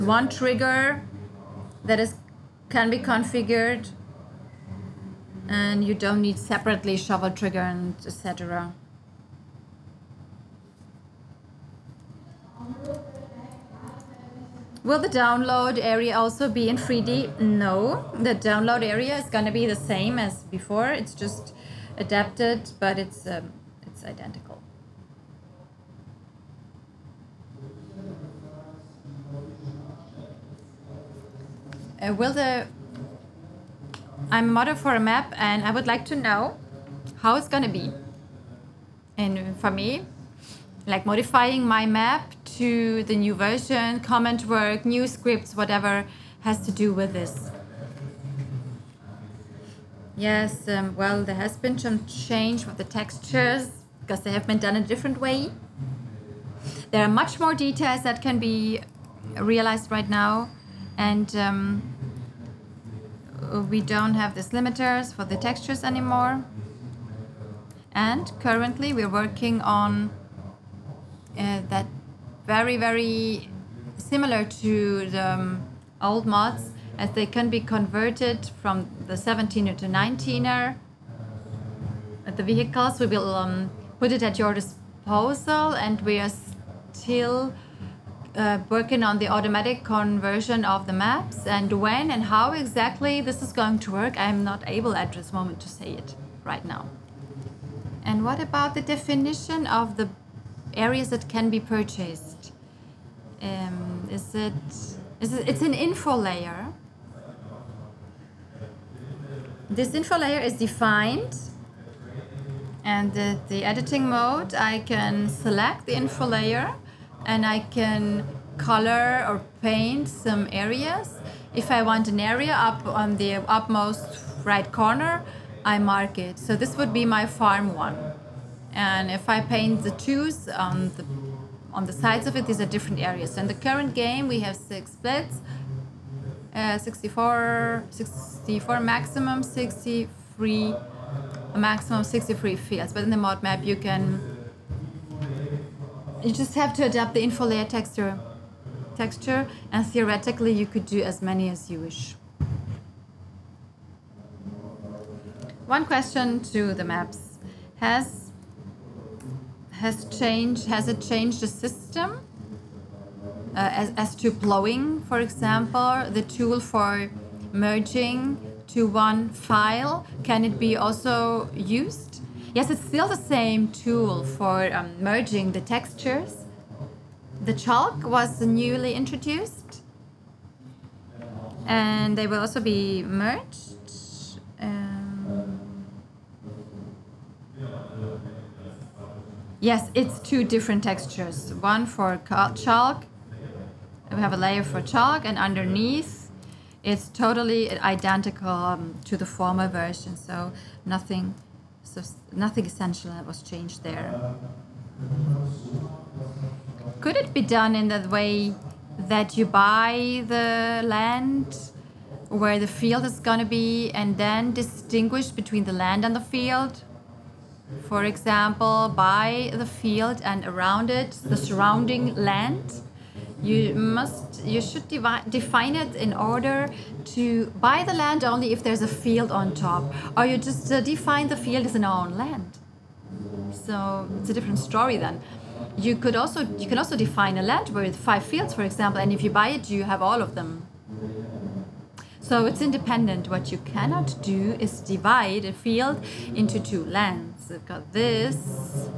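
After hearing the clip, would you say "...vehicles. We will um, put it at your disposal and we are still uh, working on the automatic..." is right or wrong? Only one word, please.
right.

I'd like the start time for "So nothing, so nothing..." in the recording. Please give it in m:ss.
3:20.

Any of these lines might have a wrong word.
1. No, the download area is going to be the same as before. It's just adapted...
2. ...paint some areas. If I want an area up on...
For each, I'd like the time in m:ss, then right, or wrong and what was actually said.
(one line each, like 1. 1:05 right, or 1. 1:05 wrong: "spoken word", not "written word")
1. 0:17 right
2. 1:59 right.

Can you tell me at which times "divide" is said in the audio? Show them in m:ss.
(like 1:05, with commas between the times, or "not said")
3:44, 4:04.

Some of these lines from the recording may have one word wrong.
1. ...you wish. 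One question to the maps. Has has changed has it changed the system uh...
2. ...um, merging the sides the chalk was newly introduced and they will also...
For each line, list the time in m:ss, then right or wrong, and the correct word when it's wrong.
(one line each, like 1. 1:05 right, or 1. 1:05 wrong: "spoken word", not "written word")
1. 2:31 right
2. 2:54 wrong: "textures", not "sides".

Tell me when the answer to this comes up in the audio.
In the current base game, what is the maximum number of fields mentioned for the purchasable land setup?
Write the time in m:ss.
2:21.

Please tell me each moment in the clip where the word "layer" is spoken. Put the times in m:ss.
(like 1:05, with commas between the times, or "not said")
1:46, 1:50, 1:56, 2:27, 3:14.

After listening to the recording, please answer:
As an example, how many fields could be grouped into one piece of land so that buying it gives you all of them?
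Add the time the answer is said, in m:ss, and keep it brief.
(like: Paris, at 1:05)
5, at 3:57.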